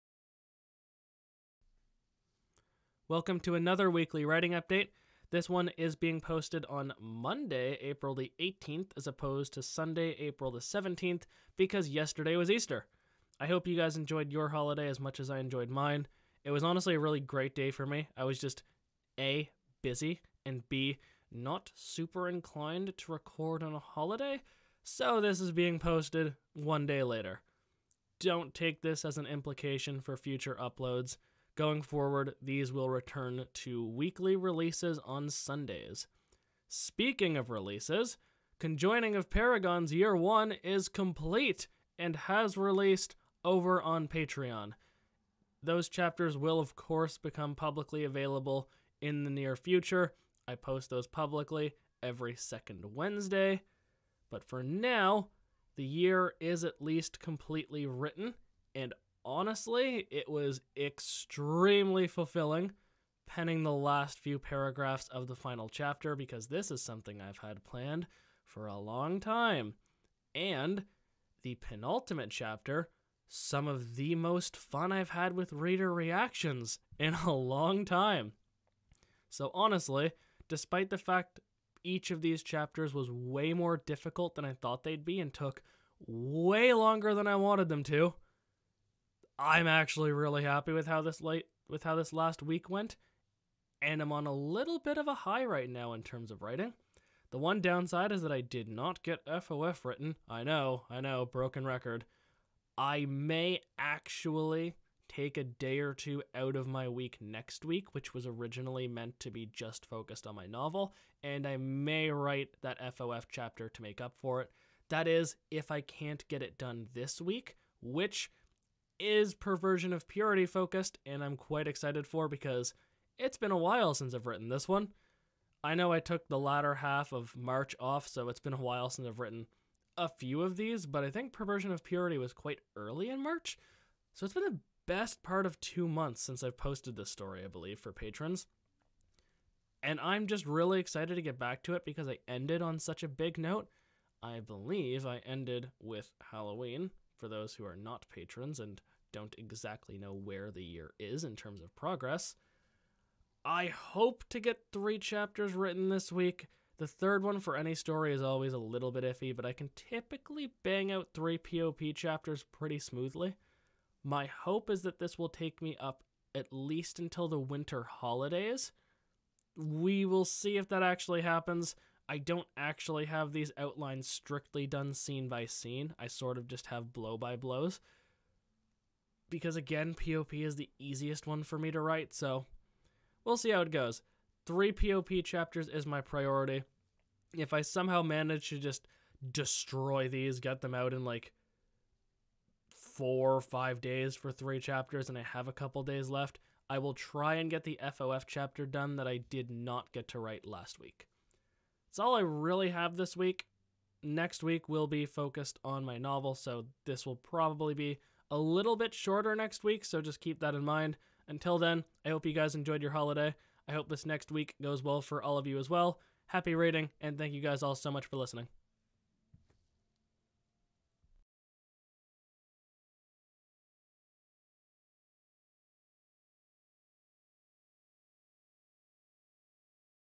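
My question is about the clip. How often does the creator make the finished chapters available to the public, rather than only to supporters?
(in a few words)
Every second Wednesday.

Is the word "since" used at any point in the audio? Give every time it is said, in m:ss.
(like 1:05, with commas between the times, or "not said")
2:03, 2:08, 2:16.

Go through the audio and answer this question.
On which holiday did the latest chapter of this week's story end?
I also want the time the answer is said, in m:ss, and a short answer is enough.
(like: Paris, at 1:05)
Halloween, at 2:26.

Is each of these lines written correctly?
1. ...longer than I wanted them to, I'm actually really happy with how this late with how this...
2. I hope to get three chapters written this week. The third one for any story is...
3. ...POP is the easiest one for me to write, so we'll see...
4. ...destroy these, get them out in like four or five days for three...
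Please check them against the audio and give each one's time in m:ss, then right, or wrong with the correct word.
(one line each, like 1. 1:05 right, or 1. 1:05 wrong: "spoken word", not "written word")
1. 1:26 right
2. 2:33 right
3. 2:59 right
4. 3:09 right.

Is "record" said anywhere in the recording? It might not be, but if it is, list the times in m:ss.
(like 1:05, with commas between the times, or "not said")
0:23, 1:41.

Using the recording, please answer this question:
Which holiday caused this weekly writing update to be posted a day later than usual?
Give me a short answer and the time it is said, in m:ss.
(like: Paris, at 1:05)
Easter, at 0:12.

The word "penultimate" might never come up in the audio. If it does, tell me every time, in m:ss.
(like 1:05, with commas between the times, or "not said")
1:11.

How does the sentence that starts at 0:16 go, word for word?
It was honestly a really great day for me.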